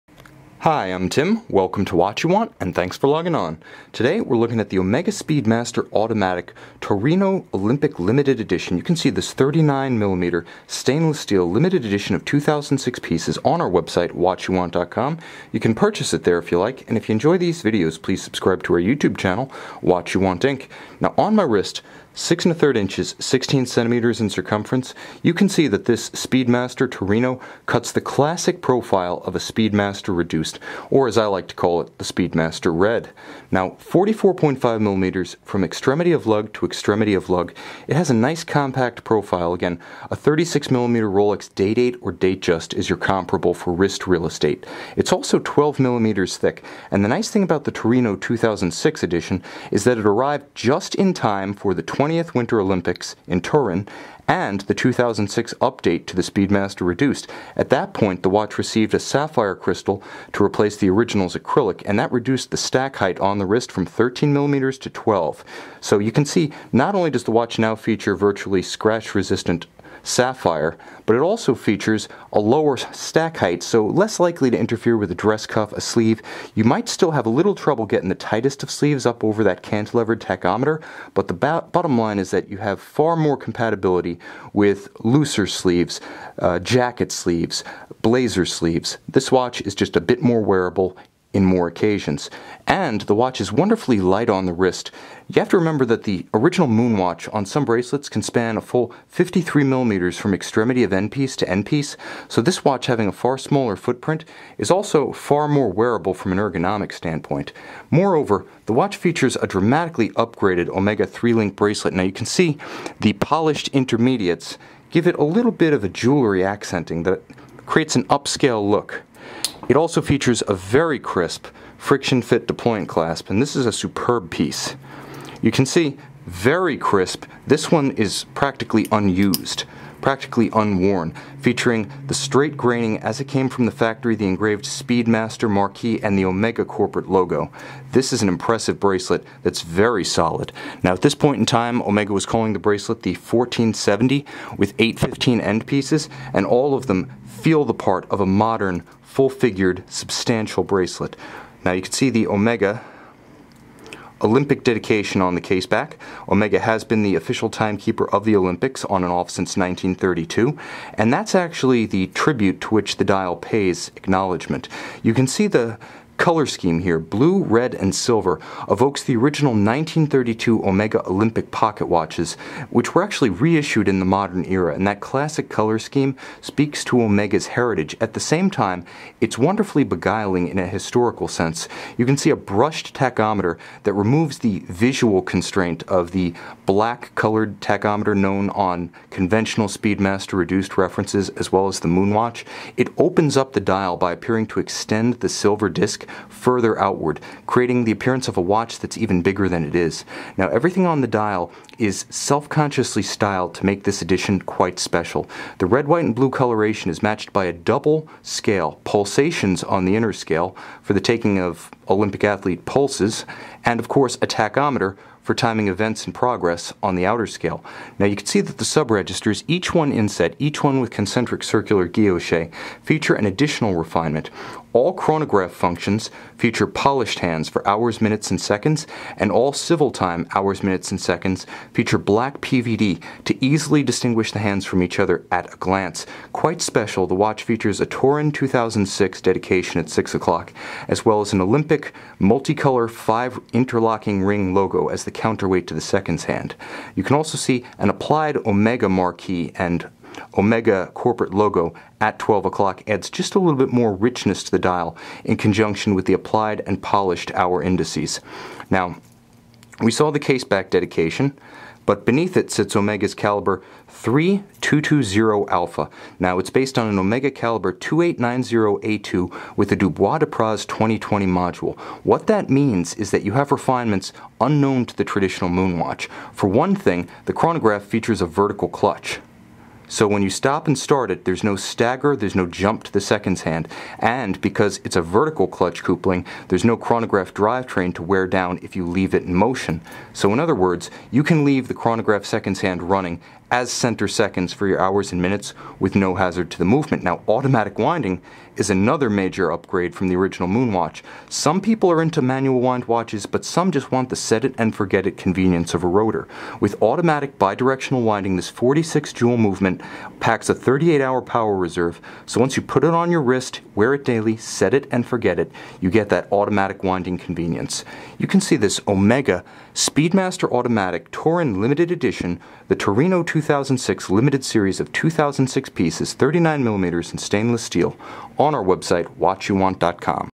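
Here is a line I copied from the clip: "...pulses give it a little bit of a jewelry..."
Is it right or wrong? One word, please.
wrong.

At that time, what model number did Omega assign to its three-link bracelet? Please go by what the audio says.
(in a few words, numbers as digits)
1470.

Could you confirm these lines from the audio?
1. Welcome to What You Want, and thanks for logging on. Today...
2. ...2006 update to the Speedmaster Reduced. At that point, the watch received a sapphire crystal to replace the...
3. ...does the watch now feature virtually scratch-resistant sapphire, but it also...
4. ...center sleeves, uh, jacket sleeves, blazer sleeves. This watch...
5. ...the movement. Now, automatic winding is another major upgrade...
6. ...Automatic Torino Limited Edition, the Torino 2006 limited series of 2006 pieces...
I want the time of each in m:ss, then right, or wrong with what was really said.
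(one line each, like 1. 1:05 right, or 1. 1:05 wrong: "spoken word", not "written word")
1. 0:01 right
2. 0:54 right
3. 1:07 right
4. 1:24 wrong: "looser", not "center"
5. 4:56 right
6. 5:20 right.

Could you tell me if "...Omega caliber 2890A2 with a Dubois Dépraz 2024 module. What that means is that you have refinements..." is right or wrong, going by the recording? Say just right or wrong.
wrong.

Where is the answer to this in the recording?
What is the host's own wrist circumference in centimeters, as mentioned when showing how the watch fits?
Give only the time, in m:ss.
0:23.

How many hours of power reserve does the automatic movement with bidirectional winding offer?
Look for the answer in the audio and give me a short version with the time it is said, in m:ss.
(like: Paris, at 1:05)
38, at 5:10.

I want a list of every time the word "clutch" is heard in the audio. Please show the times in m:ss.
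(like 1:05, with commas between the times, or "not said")
4:38, 4:45.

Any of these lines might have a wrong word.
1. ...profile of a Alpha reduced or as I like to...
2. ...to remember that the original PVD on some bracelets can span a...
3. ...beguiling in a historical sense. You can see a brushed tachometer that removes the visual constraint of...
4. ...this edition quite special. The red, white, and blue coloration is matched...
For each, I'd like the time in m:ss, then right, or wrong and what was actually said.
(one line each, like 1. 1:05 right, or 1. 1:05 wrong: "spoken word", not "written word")
1. 0:28 wrong: "Speedmaster", not "Alpha"
2. 1:35 wrong: "Moonwatch", not "PVD"
3. 2:59 right
4. 3:23 right.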